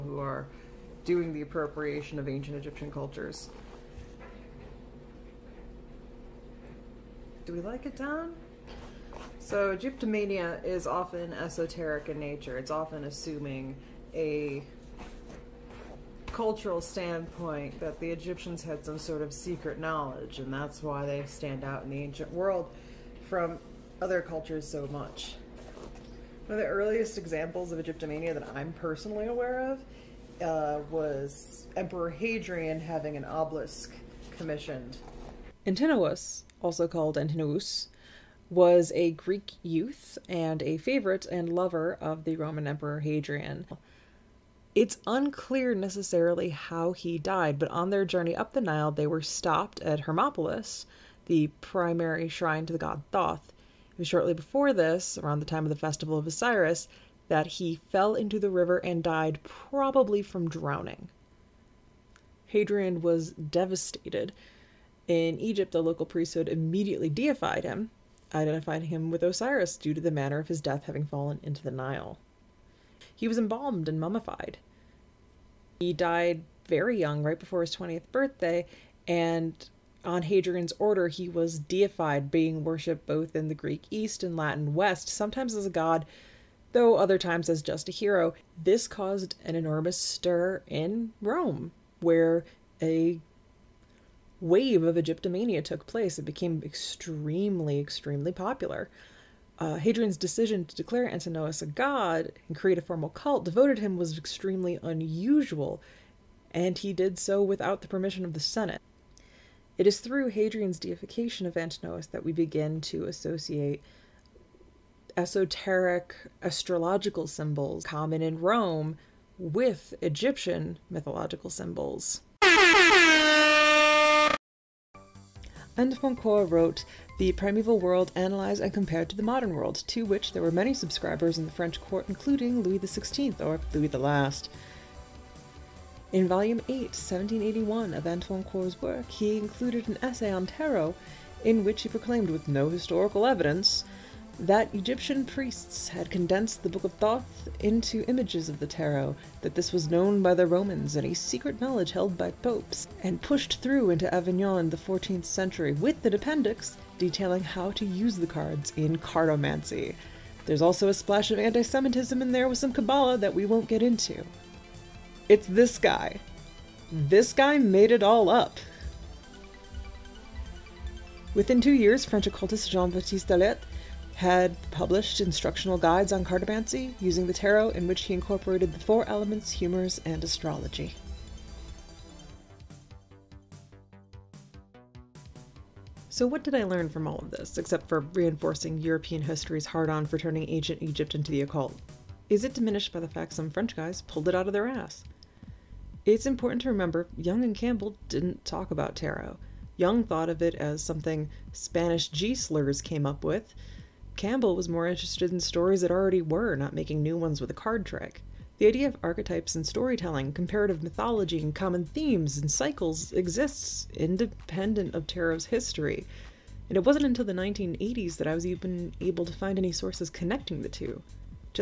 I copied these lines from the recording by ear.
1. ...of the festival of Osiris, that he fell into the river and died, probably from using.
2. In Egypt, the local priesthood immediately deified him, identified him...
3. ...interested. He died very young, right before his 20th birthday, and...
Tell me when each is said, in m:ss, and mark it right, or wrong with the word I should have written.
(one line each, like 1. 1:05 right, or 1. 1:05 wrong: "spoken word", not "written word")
1. 0:55 wrong: "drowning", not "using"
2. 1:05 right
3. 1:13 wrong: "mummified", not "interested".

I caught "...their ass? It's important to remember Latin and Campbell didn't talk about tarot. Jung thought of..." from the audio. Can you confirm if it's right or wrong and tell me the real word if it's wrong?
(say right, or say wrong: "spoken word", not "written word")
wrong: "Jung", not "Latin".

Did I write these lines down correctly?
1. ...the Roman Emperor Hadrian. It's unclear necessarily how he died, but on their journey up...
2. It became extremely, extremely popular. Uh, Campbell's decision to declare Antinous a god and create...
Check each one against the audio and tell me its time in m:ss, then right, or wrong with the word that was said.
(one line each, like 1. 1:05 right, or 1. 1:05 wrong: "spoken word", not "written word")
1. 0:42 right
2. 1:36 wrong: "Hadrian", not "Campbell".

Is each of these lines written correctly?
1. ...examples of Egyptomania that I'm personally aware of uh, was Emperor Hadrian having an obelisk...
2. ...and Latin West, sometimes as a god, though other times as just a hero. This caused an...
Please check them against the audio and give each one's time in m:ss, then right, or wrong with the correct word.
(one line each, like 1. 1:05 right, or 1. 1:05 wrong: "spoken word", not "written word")
1. 0:27 right
2. 1:24 right.